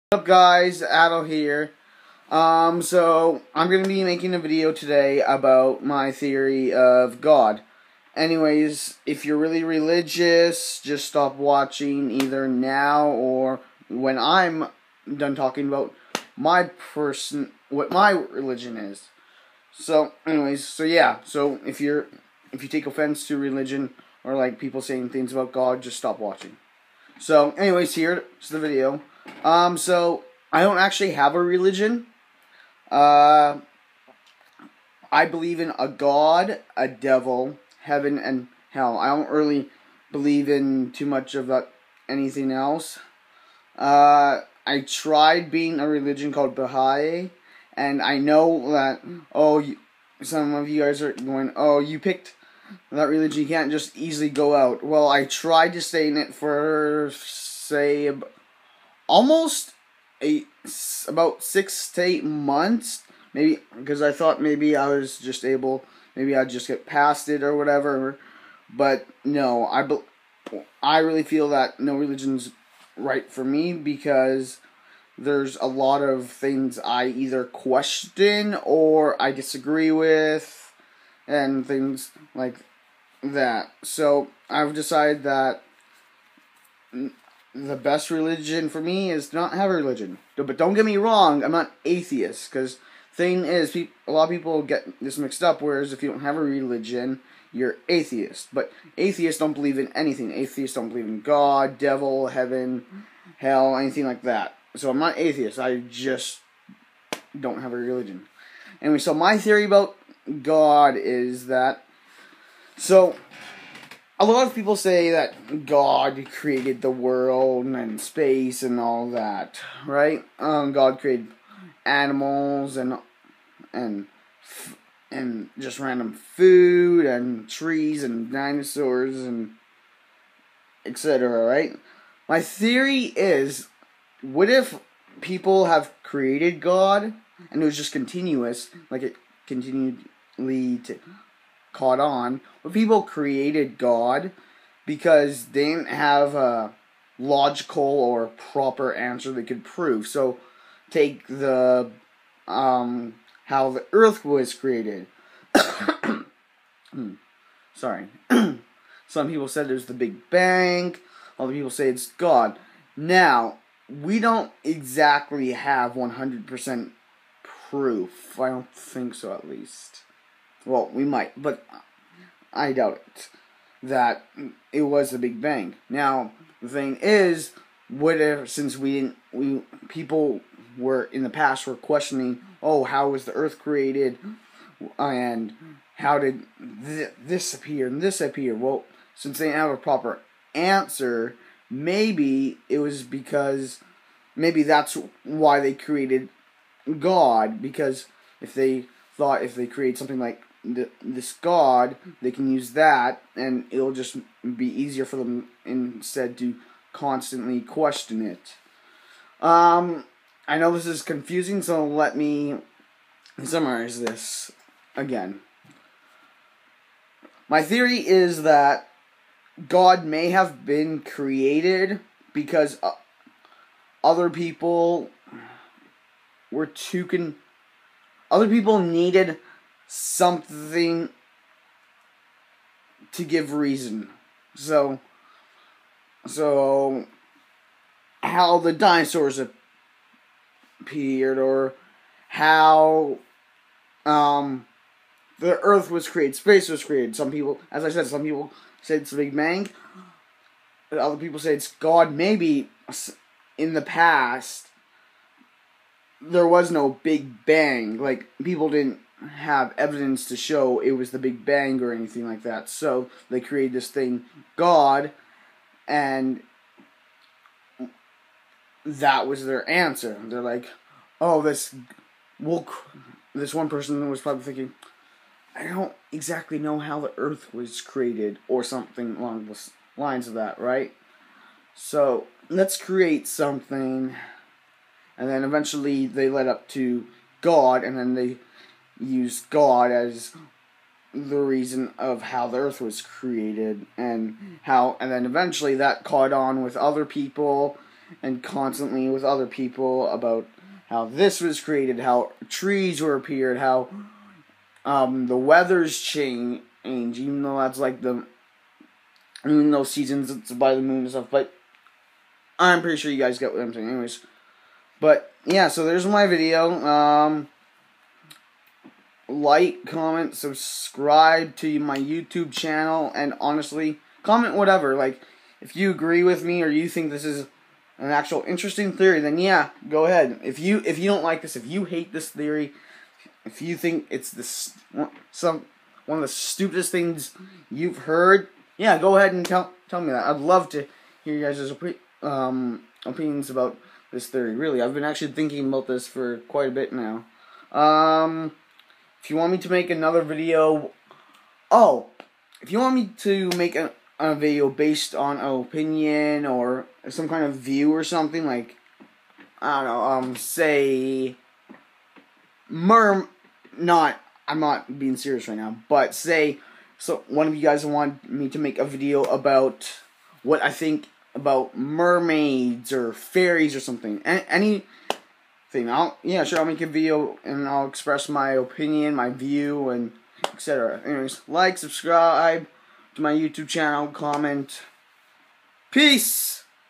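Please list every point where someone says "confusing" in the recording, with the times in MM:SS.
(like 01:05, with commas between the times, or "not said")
03:31.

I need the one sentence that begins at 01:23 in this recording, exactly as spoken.
So I've decided that the best religion for me is to not have a religion.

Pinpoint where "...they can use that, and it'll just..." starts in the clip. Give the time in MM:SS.
03:22.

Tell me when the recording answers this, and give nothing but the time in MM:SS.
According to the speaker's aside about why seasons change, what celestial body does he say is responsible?
05:10.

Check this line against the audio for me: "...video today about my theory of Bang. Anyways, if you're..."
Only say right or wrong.
wrong.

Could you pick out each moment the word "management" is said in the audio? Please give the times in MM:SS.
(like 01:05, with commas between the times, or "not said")
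not said.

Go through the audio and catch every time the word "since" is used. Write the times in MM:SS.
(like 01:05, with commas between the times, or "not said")
02:58, 03:09.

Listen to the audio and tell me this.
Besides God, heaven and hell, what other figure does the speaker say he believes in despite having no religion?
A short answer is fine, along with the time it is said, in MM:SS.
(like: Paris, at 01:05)
a devil, at 00:36.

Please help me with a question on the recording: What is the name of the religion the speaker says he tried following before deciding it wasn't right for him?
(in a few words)
Baha'i.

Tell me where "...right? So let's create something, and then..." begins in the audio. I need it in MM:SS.
04:40.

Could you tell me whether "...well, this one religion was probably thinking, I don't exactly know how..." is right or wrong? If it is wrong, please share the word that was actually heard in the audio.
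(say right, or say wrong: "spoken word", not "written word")
wrong: "person", not "religion".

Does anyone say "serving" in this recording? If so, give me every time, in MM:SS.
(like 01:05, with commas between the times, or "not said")
not said.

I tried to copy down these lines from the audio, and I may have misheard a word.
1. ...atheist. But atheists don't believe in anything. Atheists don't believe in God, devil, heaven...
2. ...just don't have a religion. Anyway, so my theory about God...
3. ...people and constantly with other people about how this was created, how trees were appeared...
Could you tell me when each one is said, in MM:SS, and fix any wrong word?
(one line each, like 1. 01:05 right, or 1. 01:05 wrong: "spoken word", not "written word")
1. 01:37 right
2. 01:45 right
3. 04:57 right.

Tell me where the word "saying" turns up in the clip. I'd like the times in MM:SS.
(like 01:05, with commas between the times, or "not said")
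00:24, 05:13.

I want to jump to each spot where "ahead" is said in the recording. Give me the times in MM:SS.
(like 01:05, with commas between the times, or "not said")
05:30, 05:39.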